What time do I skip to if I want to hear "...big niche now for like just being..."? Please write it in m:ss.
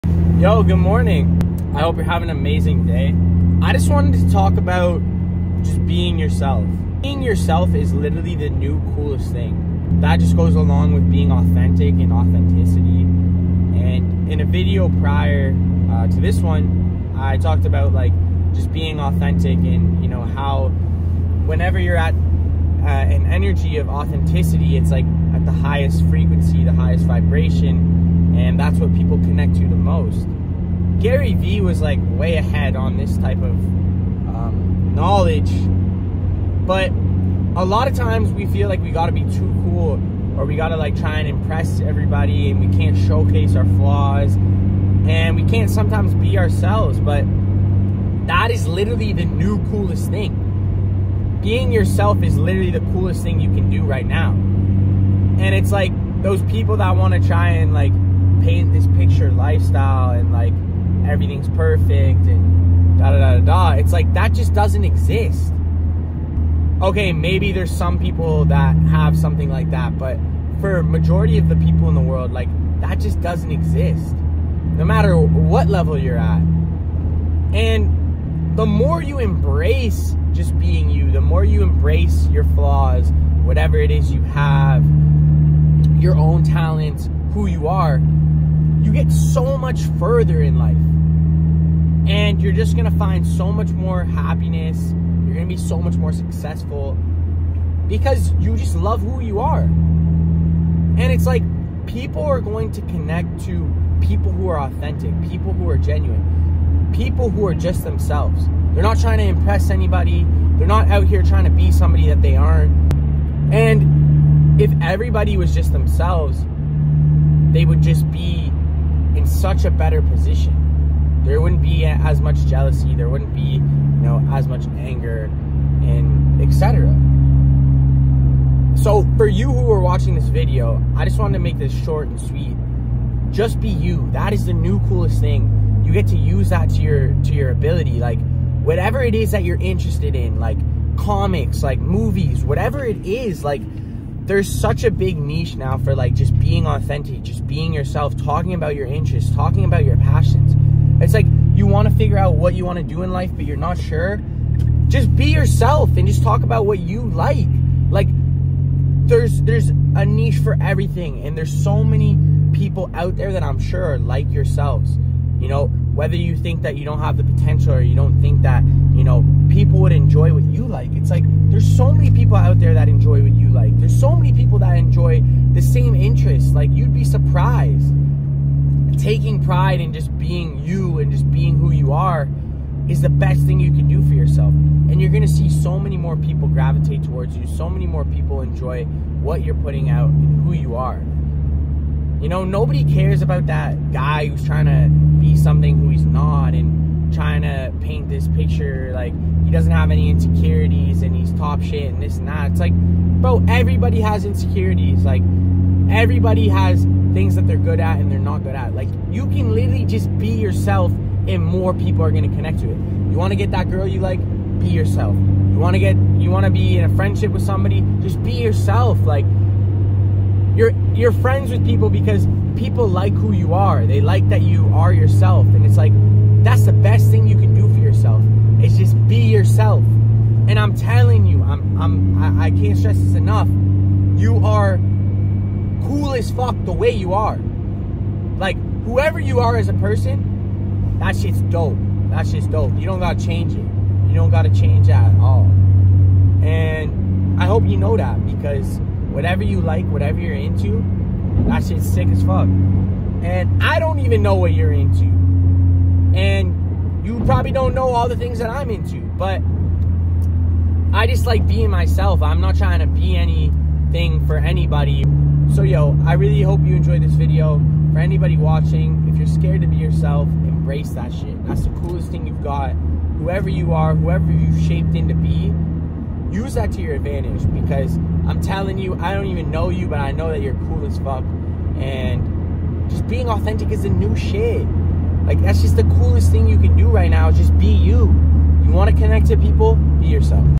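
2:24.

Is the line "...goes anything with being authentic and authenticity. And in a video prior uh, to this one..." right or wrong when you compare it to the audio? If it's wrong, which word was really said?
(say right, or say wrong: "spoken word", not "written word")
wrong: "along", not "anything".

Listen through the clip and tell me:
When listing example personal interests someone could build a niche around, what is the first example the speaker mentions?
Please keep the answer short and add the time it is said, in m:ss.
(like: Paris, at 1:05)
comics, at 2:20.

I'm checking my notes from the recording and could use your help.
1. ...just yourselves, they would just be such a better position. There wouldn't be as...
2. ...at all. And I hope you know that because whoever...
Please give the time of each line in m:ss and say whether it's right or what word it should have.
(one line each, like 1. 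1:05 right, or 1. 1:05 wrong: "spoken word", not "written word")
1. 1:55 wrong: "themselves", not "yourselves"
2. 4:05 wrong: "whatever", not "whoever".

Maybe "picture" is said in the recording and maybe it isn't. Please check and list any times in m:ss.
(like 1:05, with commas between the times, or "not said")
0:58, 3:18.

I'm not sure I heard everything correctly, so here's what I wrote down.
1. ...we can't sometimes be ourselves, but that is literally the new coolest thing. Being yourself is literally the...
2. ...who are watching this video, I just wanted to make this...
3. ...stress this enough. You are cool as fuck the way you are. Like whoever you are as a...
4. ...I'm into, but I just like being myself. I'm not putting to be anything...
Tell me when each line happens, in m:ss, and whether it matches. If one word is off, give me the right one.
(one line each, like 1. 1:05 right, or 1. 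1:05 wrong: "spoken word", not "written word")
1. 0:45 right
2. 2:09 right
3. 3:52 right
4. 4:18 wrong: "trying", not "putting".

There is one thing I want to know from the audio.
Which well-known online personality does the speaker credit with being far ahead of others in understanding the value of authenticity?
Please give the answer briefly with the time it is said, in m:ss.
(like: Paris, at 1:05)
Gary Vee, at 0:31.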